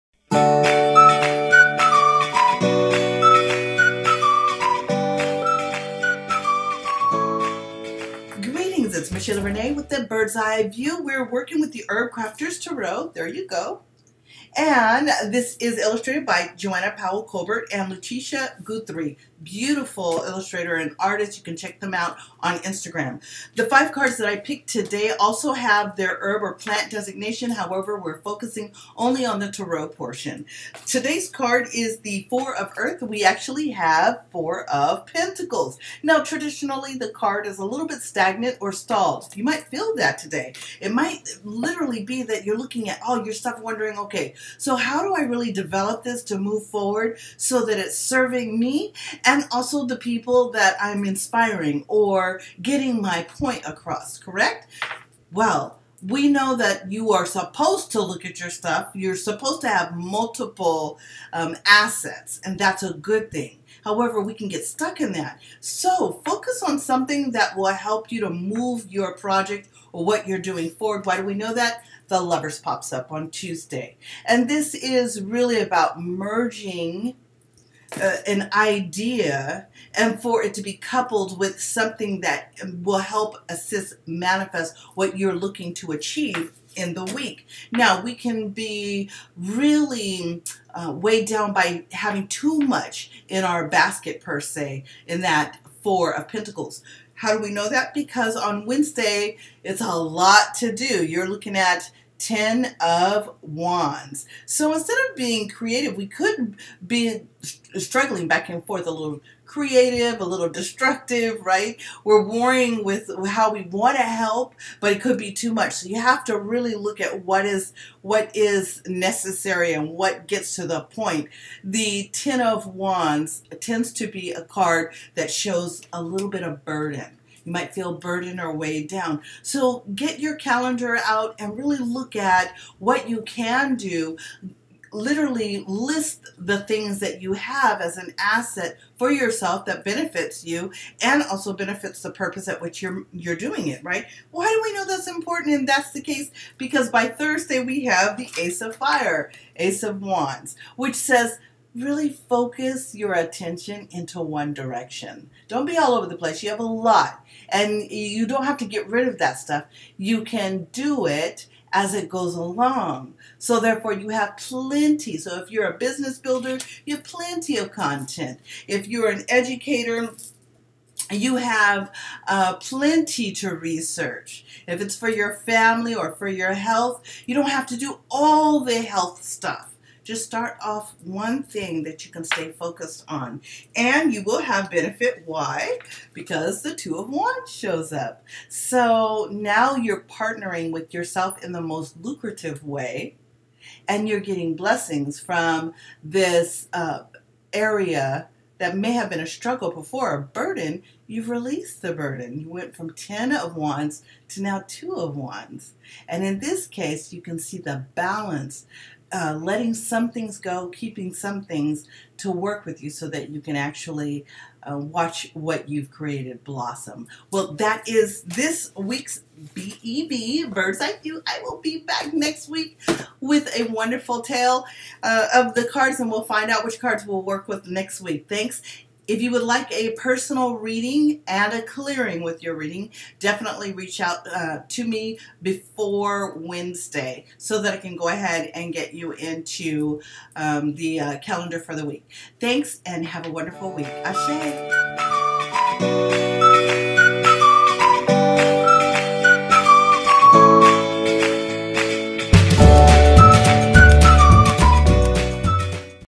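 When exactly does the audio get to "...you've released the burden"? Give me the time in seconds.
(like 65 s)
201 s.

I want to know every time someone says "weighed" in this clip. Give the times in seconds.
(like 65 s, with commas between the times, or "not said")
90 s, 128 s.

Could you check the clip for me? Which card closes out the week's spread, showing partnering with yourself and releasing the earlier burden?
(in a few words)
Two of Wands.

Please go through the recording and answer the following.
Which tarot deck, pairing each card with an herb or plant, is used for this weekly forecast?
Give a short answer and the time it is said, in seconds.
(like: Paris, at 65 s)
Herbcrafters Tarot, at 11 s.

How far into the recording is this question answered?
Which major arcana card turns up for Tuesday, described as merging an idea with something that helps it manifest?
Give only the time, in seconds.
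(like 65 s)
72 s.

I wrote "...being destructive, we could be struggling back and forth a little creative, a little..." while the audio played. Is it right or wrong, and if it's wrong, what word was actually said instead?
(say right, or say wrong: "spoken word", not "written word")
wrong: "creative", not "destructive".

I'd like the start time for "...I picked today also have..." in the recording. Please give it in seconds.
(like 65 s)
24 s.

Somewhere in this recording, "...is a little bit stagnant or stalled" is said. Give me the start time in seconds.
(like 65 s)
37 s.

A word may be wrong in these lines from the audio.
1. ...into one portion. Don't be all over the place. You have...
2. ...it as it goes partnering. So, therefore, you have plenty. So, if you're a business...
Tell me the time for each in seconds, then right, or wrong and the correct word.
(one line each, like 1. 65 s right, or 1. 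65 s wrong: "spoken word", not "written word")
1. 153 s wrong: "direction", not "portion"
2. 161 s wrong: "along", not "partnering".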